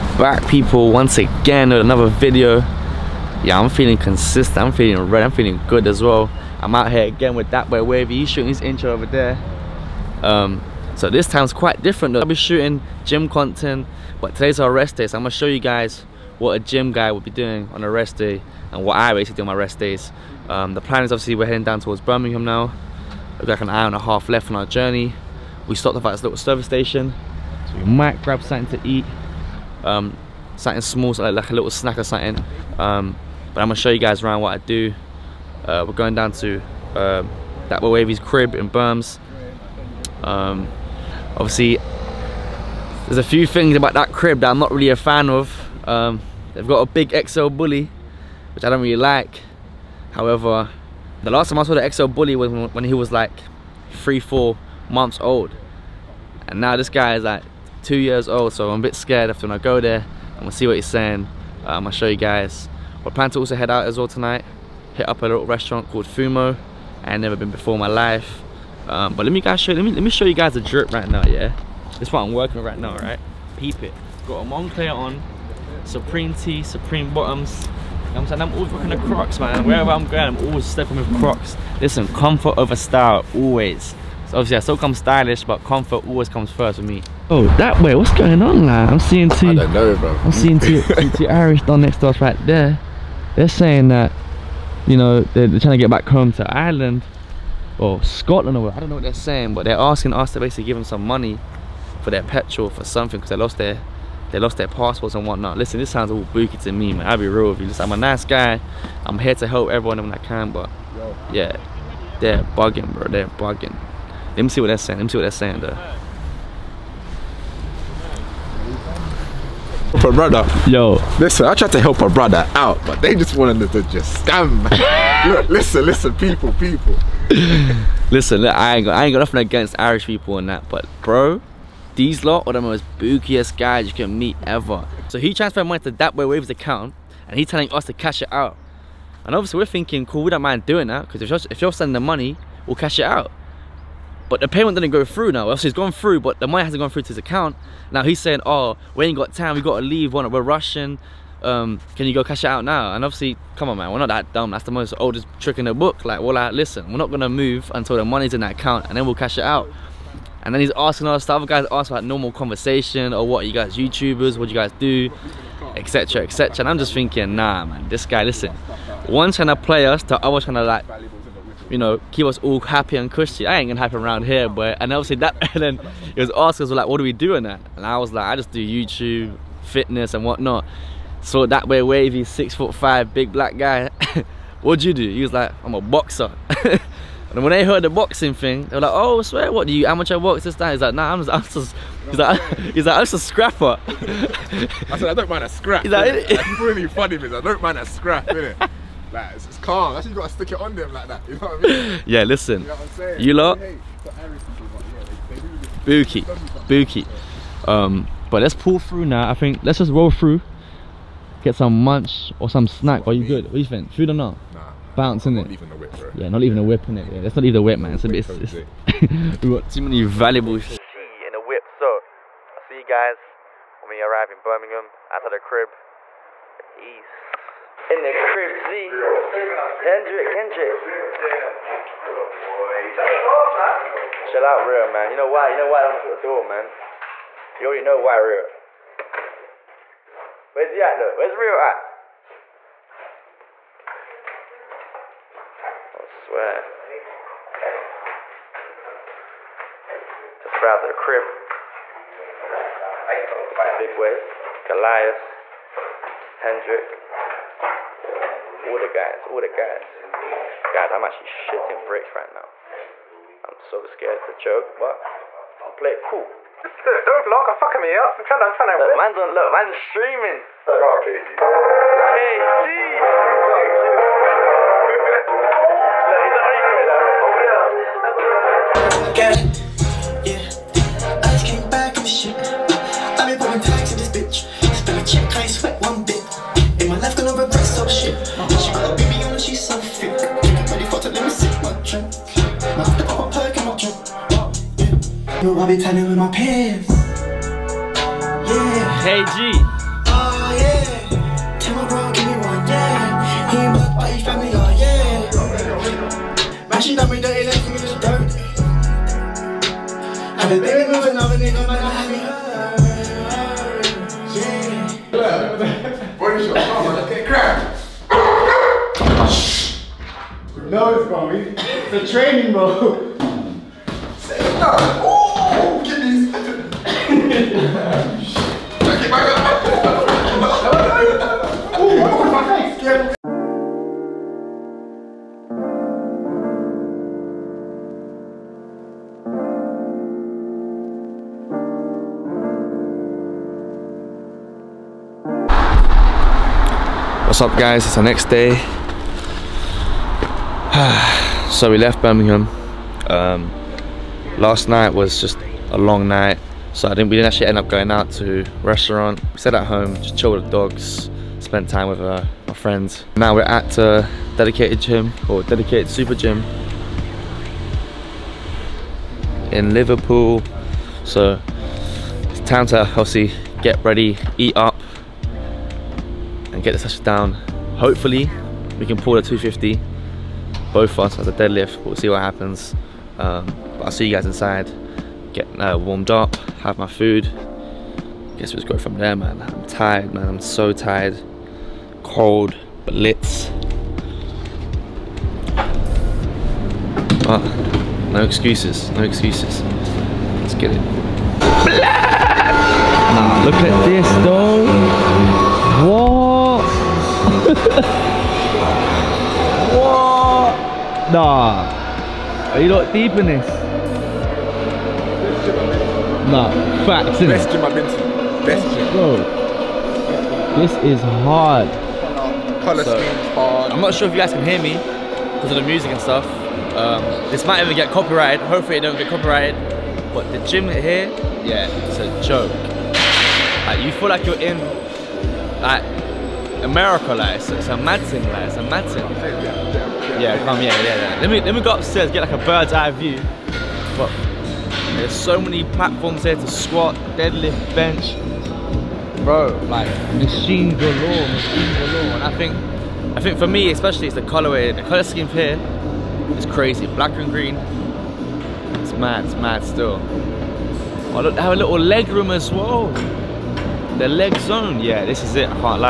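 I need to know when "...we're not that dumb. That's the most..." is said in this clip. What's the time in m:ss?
2:33.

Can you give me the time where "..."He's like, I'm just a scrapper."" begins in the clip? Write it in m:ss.
3:12.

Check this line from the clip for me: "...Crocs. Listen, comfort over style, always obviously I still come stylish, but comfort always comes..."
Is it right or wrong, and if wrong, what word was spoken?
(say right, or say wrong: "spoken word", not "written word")
right.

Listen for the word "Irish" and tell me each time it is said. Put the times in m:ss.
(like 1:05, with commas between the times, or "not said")
1:31, 2:09.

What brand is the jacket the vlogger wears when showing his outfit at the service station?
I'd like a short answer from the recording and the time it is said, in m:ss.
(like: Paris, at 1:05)
Moncler, at 1:14.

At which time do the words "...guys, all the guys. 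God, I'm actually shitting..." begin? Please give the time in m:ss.
4:18.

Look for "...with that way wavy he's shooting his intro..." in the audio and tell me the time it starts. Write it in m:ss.
0:07.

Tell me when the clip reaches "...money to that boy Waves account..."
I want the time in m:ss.
2:15.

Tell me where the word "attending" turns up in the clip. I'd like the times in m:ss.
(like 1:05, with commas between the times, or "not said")
not said.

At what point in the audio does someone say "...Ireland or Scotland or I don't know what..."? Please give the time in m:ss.
1:36.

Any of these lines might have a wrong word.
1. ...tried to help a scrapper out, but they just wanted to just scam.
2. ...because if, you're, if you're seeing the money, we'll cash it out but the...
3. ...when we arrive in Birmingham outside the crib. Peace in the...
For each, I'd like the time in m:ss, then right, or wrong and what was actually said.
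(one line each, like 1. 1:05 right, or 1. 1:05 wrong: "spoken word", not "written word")
1. 2:01 wrong: "brother", not "scrapper"
2. 2:21 wrong: "sending", not "seeing"
3. 3:43 right.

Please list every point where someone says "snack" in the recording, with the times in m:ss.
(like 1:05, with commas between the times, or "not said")
0:31, 3:32.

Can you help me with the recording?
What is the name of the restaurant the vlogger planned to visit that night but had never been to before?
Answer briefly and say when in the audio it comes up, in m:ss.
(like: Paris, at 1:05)
Fumo, at 1:06.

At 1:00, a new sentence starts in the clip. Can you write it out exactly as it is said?
I'm gonna see what he's saying.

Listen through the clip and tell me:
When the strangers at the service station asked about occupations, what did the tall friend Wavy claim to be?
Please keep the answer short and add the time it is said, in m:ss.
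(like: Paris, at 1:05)
A boxer, at 3:05.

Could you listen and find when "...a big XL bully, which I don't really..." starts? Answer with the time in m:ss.
0:46.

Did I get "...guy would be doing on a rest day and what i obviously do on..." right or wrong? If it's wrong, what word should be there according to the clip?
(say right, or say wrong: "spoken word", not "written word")
wrong: "basically", not "obviously".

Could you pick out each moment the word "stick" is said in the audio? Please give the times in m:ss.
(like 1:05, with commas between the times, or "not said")
3:20.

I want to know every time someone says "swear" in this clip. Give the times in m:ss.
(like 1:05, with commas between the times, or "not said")
3:09, 4:06.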